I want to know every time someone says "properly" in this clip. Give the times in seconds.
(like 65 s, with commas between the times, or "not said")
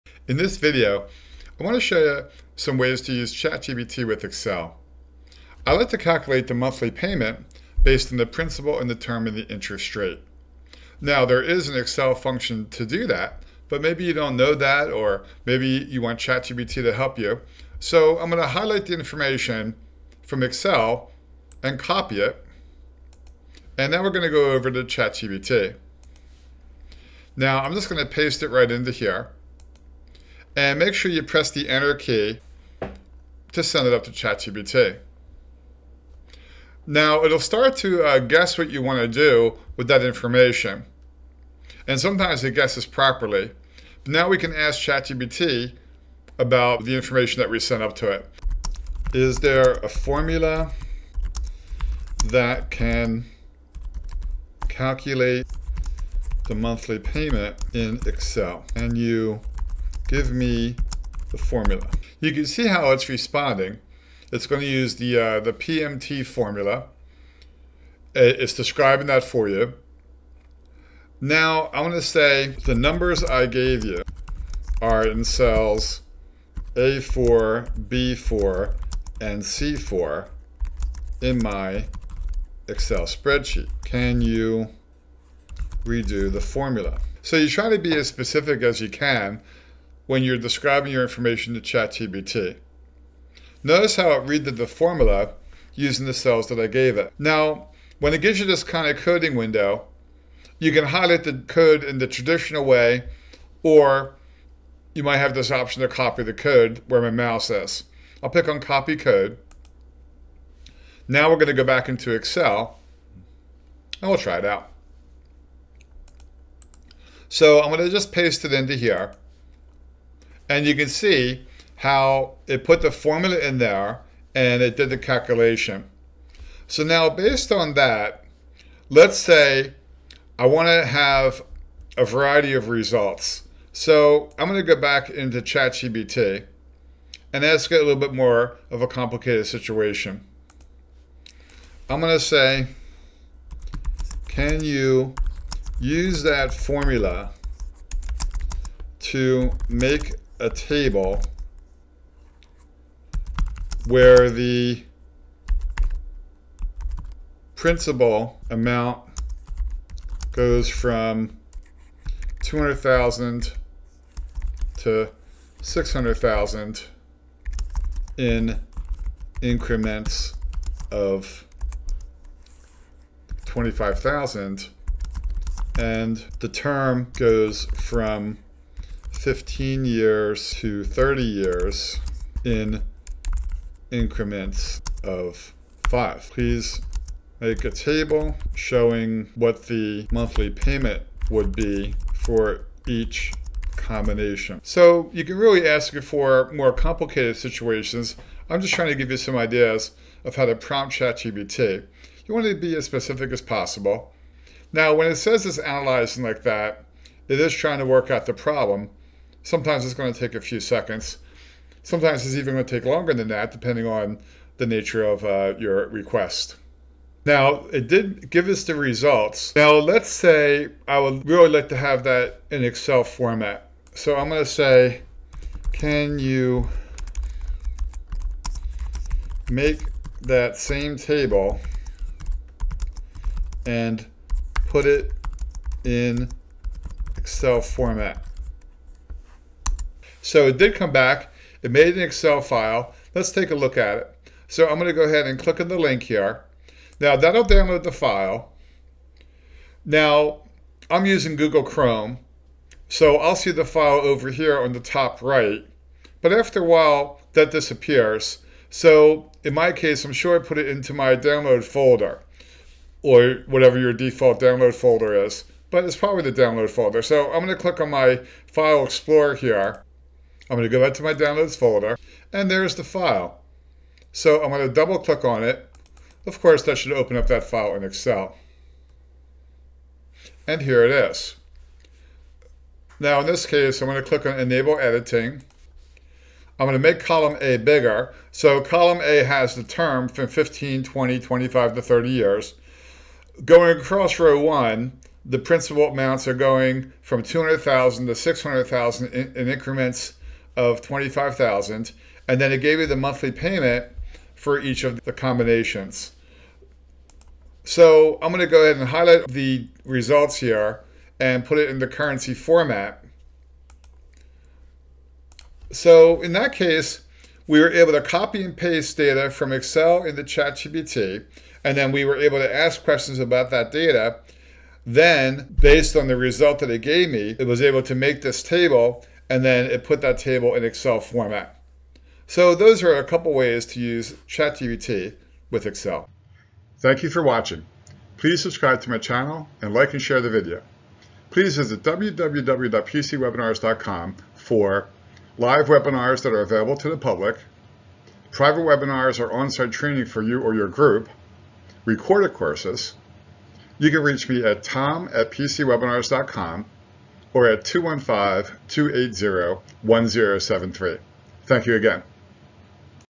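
42 s.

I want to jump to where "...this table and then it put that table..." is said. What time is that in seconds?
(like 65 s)
328 s.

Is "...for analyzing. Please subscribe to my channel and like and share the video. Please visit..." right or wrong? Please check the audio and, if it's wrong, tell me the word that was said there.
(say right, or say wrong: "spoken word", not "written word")
wrong: "watching", not "analyzing".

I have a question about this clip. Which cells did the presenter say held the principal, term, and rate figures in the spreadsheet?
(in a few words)
A4, B4, and C4.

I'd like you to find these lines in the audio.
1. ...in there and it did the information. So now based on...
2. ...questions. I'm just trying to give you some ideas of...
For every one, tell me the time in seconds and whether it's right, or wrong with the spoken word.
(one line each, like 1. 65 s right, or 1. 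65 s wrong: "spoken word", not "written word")
1. 123 s wrong: "calculation", not "information"
2. 197 s wrong: "situations", not "questions".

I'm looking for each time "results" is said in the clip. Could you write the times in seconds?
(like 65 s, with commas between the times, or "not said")
132 s, 218 s, 309 s, 326 s.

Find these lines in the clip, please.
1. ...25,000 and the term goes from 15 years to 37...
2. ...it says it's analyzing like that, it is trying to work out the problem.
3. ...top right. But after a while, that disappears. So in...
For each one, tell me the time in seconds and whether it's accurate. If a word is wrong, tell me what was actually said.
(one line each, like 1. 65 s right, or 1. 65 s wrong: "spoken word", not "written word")
1. 173 s wrong: "30", not "37"
2. 205 s right
3. 254 s right.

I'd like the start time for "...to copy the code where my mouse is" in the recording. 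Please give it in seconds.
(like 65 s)
105 s.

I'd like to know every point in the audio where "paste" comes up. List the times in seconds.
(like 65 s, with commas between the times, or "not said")
28 s, 118 s, 318 s.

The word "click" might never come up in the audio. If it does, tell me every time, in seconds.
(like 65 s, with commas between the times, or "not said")
245 s, 267 s, 274 s, 284 s.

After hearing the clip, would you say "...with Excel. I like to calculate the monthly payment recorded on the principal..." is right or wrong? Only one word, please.
wrong.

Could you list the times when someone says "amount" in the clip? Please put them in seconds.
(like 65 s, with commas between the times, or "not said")
158 s, 295 s.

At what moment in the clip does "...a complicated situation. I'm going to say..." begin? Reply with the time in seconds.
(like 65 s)
138 s.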